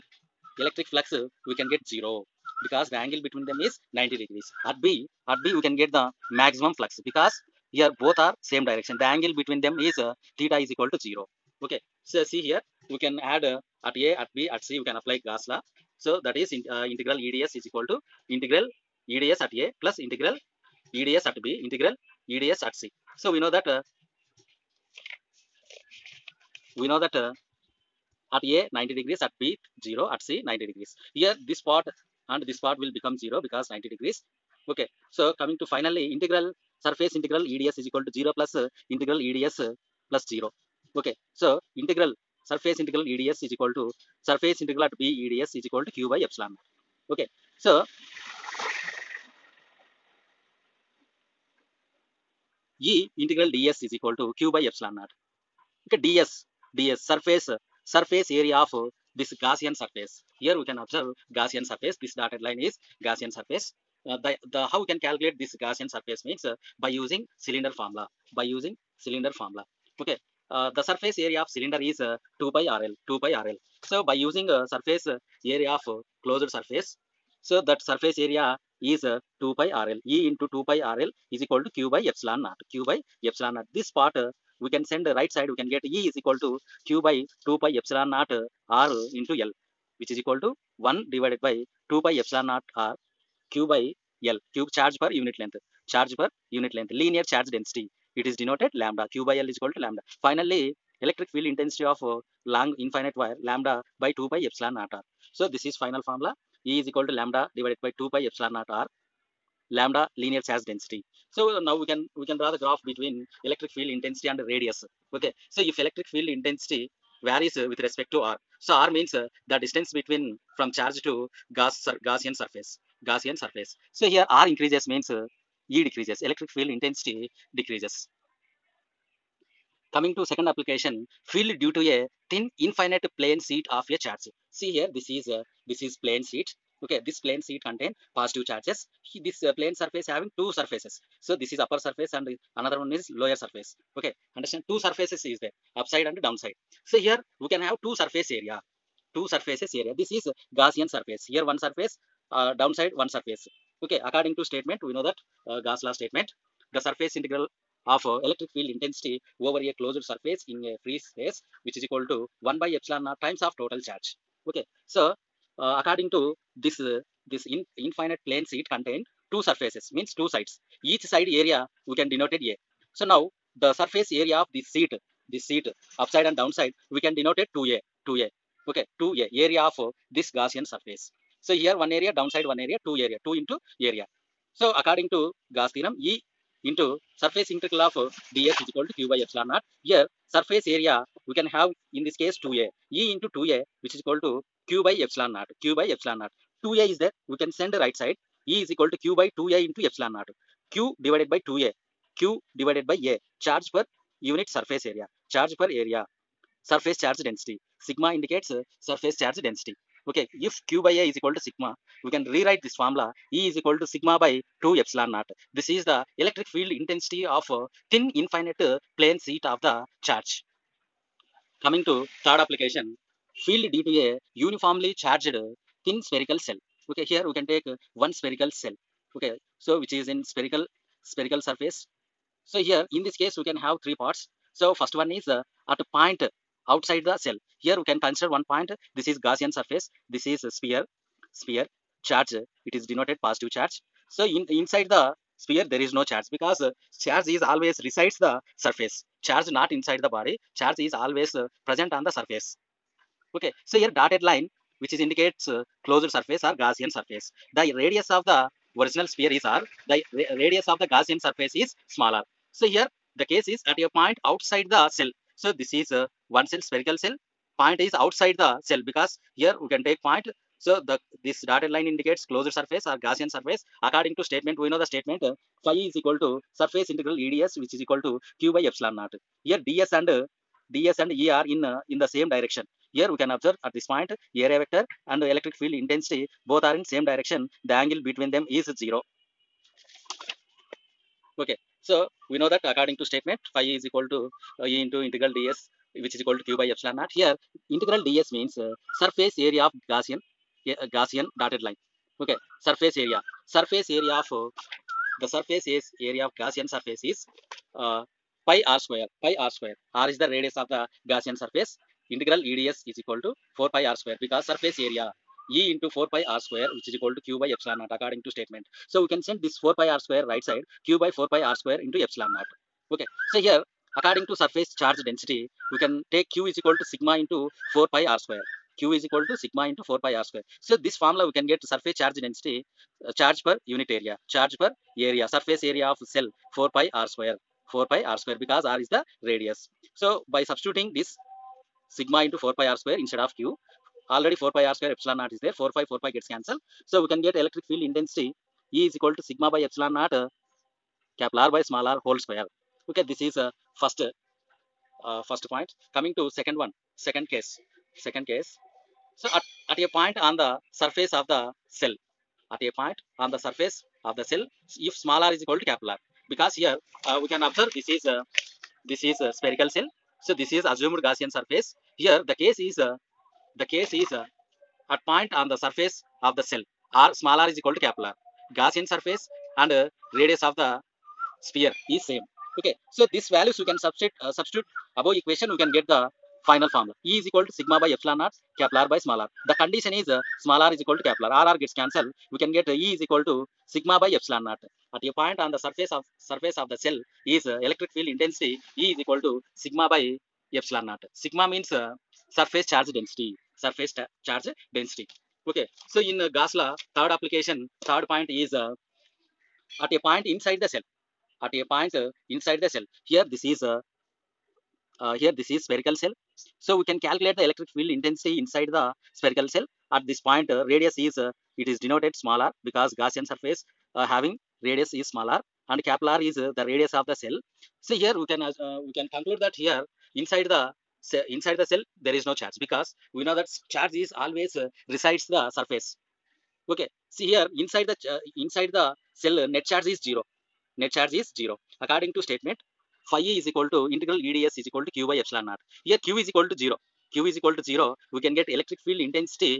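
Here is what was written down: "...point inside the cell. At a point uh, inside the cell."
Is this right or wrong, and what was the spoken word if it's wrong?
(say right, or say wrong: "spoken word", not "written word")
right.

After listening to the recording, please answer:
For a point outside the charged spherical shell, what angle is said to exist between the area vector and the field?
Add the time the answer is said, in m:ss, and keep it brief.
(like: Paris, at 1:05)
zero, at 4:47.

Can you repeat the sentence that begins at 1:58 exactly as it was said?
So r means the distance between from charge to Gaussian surface.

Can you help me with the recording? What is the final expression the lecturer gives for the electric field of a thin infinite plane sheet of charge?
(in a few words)
sigma by 2 epsilon naught.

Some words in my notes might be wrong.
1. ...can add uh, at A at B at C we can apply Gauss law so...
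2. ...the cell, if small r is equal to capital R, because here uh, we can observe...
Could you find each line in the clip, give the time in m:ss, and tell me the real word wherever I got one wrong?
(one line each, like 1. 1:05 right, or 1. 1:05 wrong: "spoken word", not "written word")
1. 0:12 right
2. 6:04 right.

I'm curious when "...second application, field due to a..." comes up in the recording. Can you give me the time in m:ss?
2:10.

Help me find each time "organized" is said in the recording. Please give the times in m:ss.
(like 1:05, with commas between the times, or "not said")
not said.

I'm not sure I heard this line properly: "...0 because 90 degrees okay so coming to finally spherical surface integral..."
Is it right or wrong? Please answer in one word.
wrong.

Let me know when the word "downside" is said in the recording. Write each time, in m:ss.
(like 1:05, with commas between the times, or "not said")
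2:26, 2:32, 2:56, 3:02.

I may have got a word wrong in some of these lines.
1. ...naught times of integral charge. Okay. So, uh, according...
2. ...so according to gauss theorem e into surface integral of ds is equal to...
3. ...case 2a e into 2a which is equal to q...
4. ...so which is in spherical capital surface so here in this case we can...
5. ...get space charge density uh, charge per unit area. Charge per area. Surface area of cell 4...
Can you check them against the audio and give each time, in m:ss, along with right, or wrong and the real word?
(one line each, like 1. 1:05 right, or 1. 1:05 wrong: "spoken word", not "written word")
1. 2:43 wrong: "total", not "integral"
2. 3:04 right
3. 3:12 right
4. 3:49 wrong: "spherical", not "capital"
5. 5:31 wrong: "surface", not "space".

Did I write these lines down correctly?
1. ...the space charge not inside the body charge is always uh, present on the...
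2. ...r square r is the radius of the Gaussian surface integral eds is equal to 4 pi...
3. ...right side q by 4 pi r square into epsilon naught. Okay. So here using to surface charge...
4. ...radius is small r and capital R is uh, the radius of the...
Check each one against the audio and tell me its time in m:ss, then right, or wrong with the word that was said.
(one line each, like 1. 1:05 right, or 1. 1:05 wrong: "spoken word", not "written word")
1. 4:08 wrong: "surface", not "space"
2. 5:09 right
3. 5:20 wrong: "according", not "using"
4. 7:04 right.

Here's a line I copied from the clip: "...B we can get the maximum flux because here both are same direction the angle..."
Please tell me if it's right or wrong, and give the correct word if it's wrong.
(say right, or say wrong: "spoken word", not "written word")
right.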